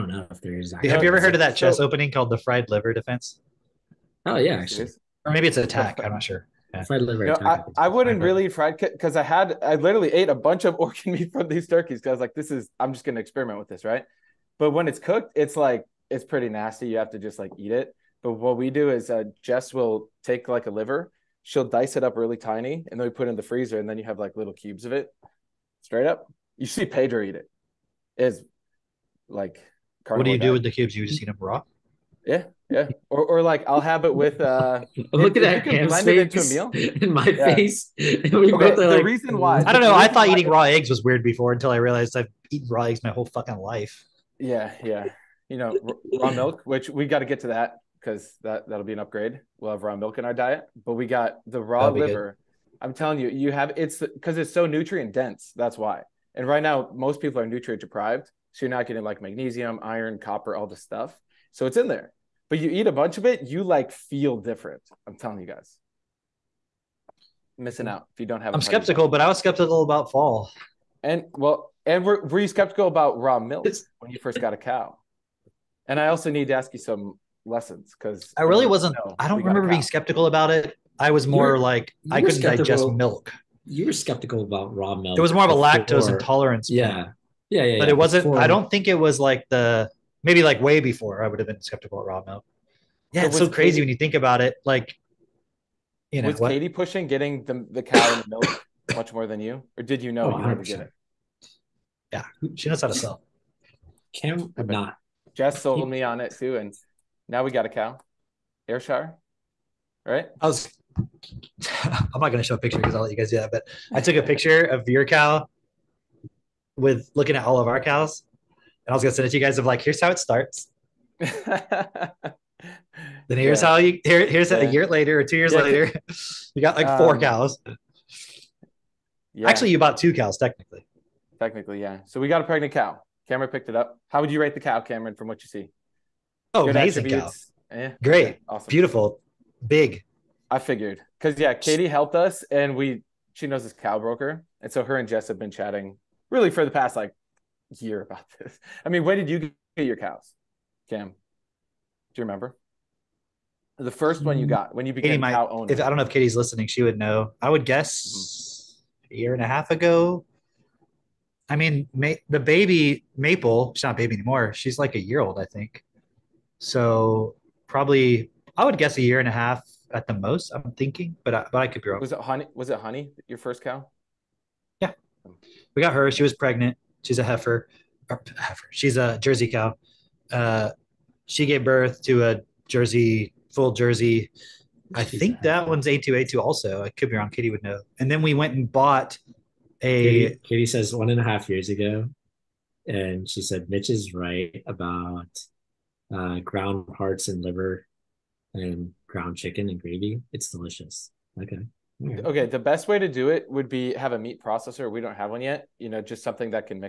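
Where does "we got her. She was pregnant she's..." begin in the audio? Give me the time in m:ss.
2:55.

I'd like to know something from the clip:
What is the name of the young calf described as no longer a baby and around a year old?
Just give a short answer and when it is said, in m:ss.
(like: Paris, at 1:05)
Maple, at 2:43.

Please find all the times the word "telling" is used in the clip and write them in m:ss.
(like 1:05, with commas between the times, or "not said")
0:52, 1:05.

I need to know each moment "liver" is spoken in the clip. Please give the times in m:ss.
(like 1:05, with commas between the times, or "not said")
0:02, 0:07, 0:20, 0:51, 3:17.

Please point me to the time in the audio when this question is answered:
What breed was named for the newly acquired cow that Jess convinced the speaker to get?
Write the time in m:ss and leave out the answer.
1:48.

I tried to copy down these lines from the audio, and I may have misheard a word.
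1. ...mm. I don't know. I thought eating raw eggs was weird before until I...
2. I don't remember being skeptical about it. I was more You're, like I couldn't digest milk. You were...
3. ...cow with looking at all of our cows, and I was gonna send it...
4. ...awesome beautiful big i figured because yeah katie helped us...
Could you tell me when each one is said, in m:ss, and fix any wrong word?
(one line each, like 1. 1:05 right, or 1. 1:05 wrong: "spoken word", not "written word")
1. 0:39 right
2. 1:19 right
3. 1:55 right
4. 2:18 right.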